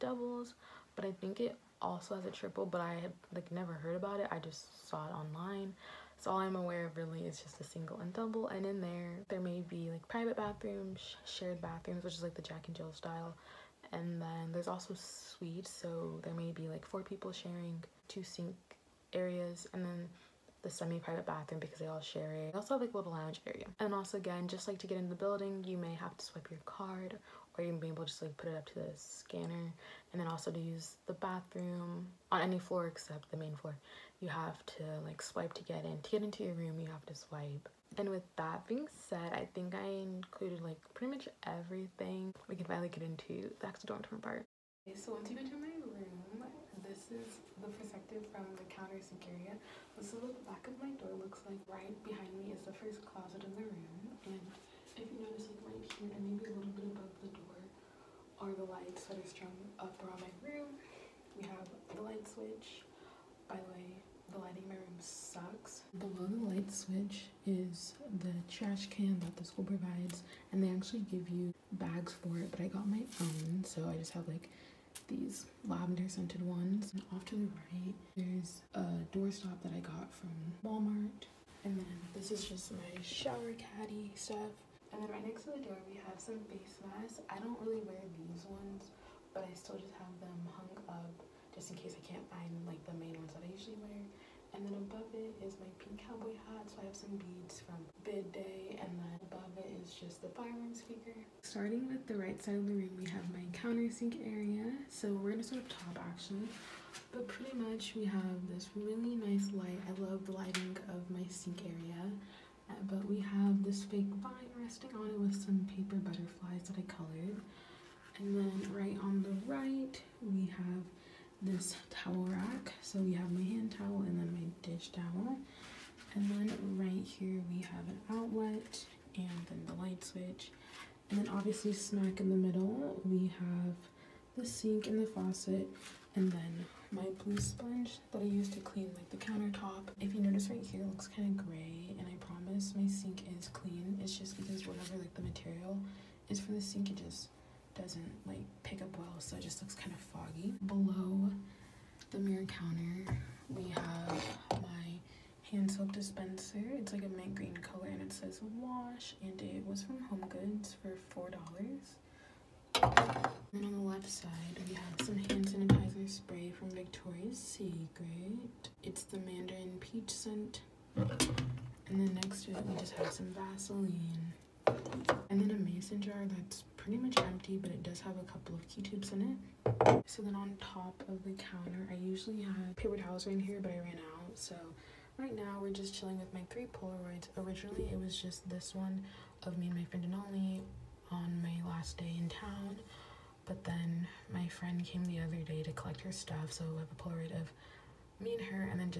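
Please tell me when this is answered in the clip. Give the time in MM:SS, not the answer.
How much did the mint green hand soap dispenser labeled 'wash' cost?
02:41.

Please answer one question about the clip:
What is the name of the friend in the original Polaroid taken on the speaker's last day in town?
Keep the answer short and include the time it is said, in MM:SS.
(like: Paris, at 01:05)
Denali, at 03:10.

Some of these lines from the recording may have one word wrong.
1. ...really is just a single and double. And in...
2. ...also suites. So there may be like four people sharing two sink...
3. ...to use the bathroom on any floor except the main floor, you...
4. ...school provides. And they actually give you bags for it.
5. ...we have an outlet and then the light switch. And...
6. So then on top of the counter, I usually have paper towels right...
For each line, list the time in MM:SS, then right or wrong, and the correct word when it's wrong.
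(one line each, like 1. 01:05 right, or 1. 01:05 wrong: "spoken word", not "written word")
1. 00:06 right
2. 00:14 right
3. 00:30 right
4. 01:09 right
5. 02:07 right
6. 03:00 right.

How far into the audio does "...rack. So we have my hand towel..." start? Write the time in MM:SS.
02:02.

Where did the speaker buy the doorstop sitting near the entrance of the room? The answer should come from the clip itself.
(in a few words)
Walmart.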